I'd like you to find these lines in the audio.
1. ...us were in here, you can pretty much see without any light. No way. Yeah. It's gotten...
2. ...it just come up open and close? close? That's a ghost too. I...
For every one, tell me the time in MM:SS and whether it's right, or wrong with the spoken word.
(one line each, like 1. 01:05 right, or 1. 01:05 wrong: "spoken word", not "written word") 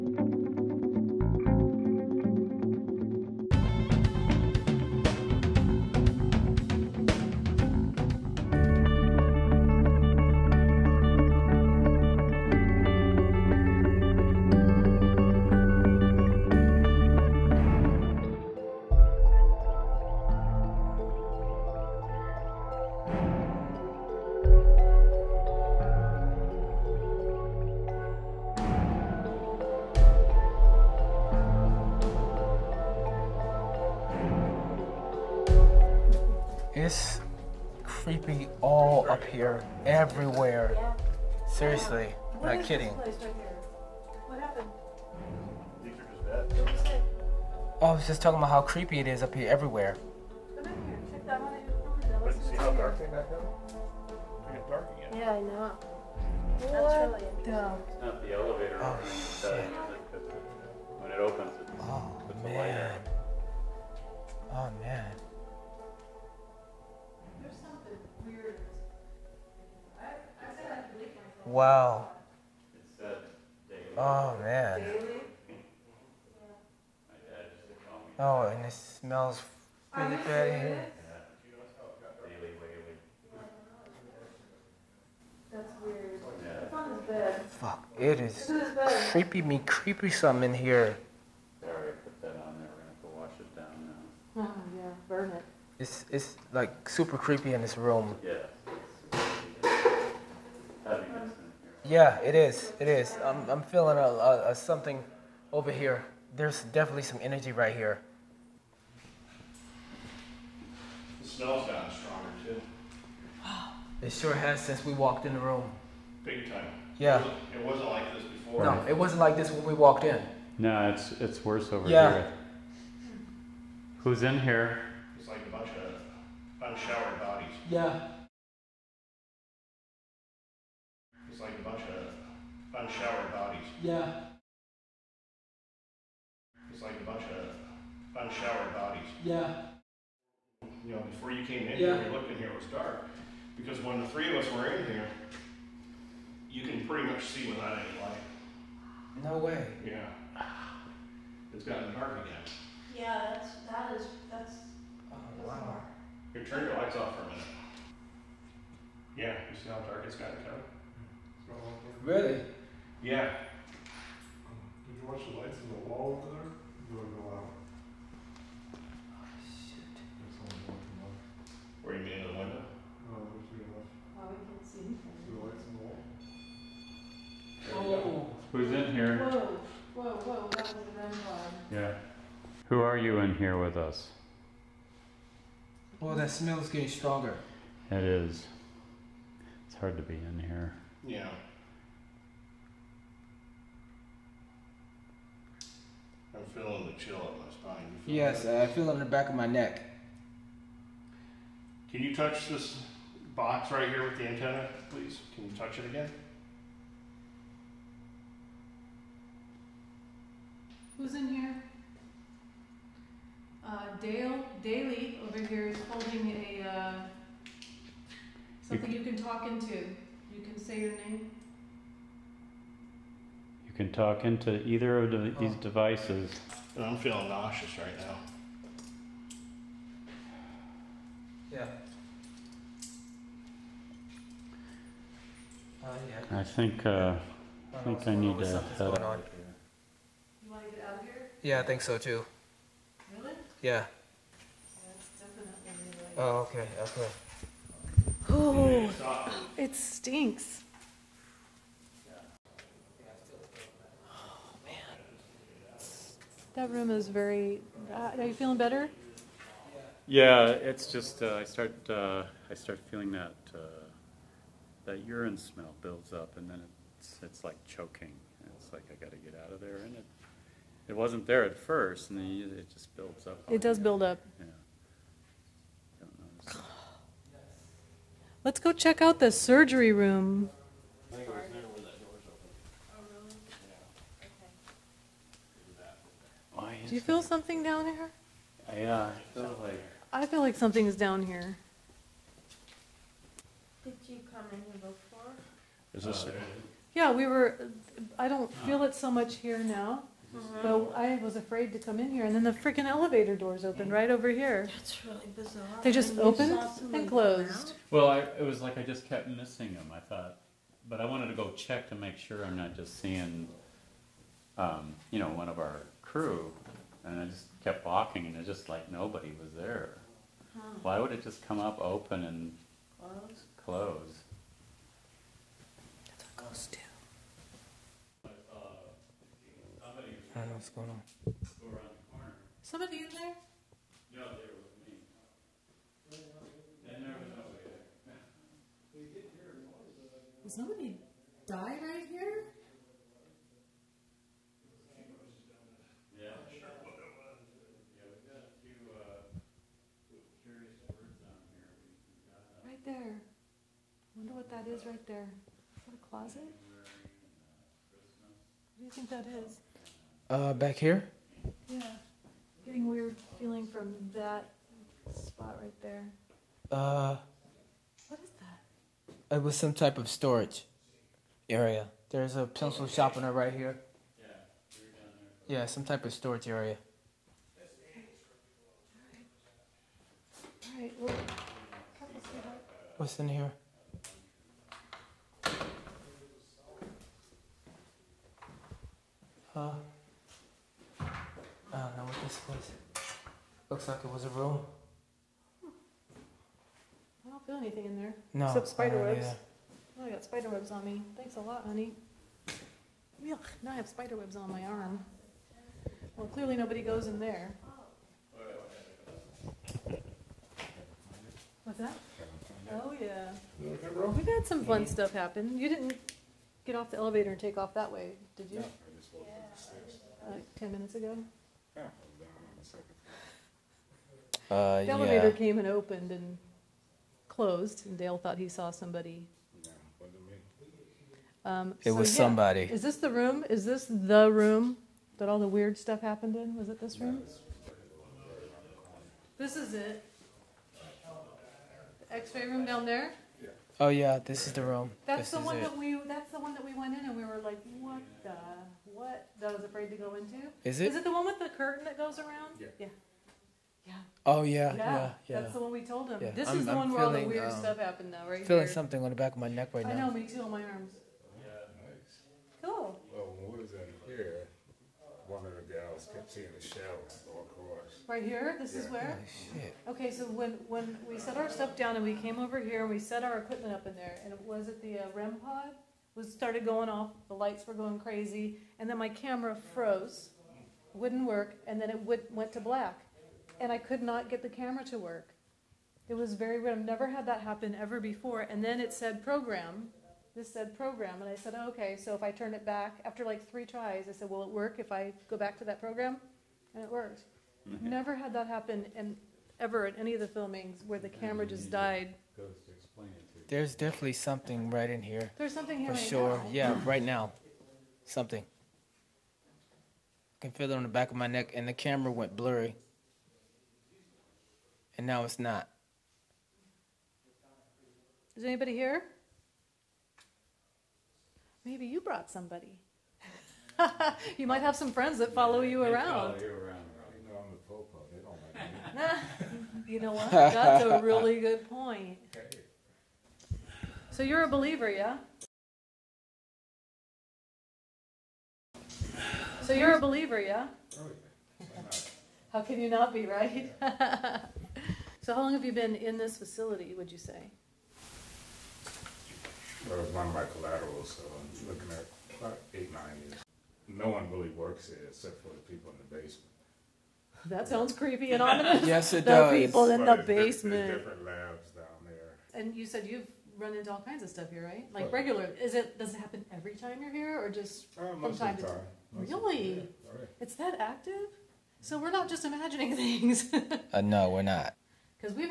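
1. 02:24 right
2. 05:21 right.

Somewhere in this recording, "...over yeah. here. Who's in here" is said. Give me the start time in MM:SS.
02:01.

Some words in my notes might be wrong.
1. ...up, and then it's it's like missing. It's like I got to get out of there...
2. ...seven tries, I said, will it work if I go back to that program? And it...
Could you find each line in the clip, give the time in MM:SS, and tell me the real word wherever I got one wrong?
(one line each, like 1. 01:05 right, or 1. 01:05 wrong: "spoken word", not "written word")
1. 04:26 wrong: "choking", not "missing"
2. 08:13 wrong: "three", not "seven".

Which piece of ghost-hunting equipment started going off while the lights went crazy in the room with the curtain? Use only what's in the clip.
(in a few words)
REM pod.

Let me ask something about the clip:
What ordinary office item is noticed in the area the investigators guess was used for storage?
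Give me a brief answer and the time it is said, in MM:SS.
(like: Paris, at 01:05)
Pencil sharpener, at 06:12.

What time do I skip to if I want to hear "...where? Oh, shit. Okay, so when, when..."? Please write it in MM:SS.
07:48.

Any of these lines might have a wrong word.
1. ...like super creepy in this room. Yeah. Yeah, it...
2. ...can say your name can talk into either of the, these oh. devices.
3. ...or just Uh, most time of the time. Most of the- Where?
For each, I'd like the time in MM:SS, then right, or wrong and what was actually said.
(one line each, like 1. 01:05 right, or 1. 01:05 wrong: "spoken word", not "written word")
1. 01:36 right
2. 03:40 right
3. 09:27 wrong: "Really", not "Where".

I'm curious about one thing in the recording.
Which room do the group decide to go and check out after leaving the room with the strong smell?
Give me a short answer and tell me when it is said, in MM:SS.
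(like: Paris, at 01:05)
The surgery room, at 04:39.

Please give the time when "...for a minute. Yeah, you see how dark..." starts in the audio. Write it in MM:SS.
02:37.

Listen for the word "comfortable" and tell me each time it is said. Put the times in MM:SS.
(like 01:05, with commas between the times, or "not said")
not said.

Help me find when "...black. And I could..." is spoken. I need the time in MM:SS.
08:02.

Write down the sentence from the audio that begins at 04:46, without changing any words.
Do you feel something down here?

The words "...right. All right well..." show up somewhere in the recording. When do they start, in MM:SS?
06:20.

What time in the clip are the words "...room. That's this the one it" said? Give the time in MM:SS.
07:24.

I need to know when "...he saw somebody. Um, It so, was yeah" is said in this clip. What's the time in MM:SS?
07:08.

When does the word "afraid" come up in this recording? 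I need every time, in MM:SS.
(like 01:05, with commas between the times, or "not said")
05:01, 07:29.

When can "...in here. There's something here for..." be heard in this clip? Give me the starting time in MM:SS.
08:24.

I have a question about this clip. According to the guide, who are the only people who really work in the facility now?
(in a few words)
The people in the basement.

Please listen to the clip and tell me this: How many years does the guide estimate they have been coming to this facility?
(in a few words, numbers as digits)
8 or 9 years.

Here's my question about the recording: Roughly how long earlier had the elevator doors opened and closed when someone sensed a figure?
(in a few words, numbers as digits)
10 minutes.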